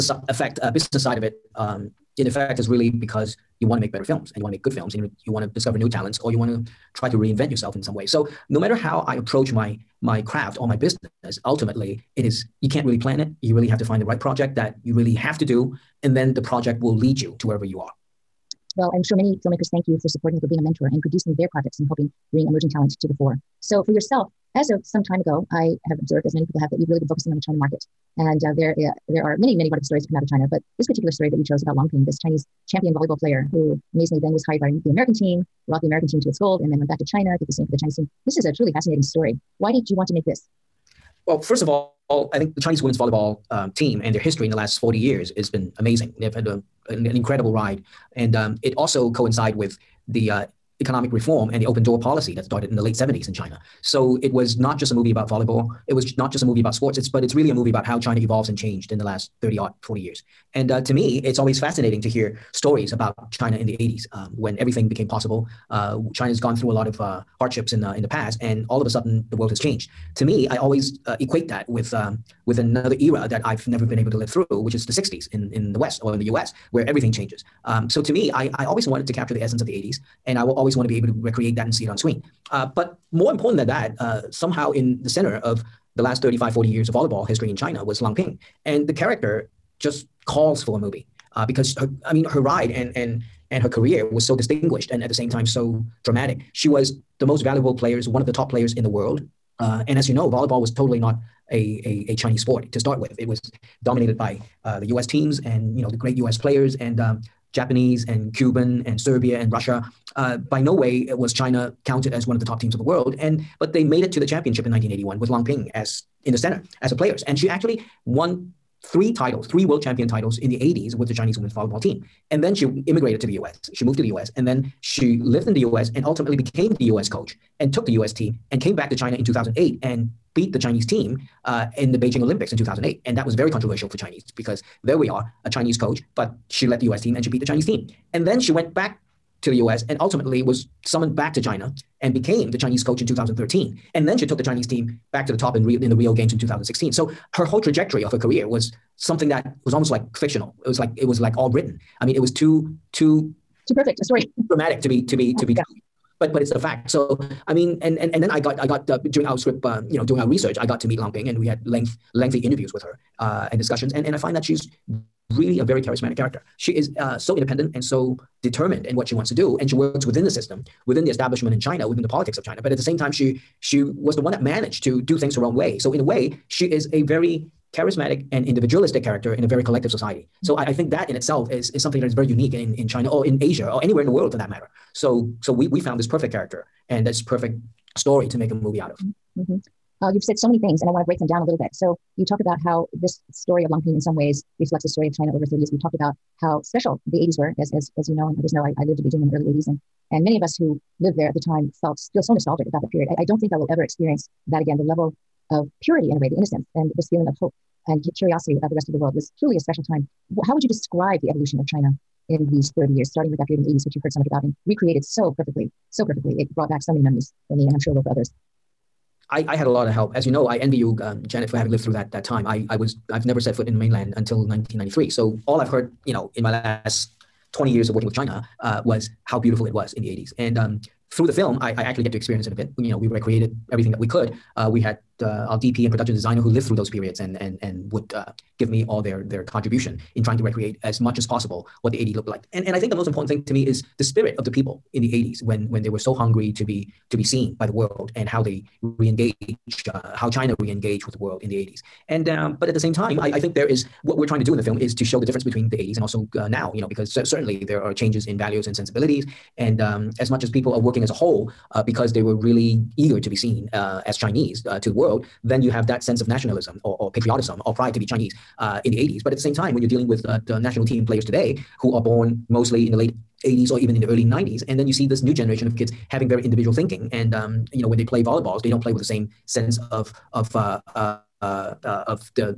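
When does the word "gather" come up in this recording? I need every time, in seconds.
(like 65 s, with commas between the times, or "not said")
not said.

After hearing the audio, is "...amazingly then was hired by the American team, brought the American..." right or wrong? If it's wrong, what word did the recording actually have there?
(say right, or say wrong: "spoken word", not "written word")
right.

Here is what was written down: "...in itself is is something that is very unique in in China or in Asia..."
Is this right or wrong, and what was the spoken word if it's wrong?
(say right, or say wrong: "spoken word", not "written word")
right.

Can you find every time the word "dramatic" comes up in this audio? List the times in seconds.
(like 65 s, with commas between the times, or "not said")
96 s, 154 s.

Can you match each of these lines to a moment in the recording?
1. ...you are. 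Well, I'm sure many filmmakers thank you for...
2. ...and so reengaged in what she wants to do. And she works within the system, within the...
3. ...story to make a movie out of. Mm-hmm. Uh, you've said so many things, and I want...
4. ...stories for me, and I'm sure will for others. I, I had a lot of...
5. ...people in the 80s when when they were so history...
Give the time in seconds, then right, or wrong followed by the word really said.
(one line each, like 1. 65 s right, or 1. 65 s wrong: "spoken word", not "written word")
1. 17 s right
2. 167 s wrong: "determined", not "reengaged"
3. 187 s right
4. 217 s wrong: "memories", not "stories"
5. 244 s wrong: "hungry", not "history".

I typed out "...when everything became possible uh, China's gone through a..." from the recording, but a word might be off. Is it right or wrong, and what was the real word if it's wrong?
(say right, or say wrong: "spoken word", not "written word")
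right.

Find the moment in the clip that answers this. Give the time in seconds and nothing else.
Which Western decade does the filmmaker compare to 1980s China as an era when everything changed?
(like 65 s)
74 s.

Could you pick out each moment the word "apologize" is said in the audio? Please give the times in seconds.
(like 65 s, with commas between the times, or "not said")
not said.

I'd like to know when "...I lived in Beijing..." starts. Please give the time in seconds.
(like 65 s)
198 s.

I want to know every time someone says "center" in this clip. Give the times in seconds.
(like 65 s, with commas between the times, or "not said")
85 s, 116 s.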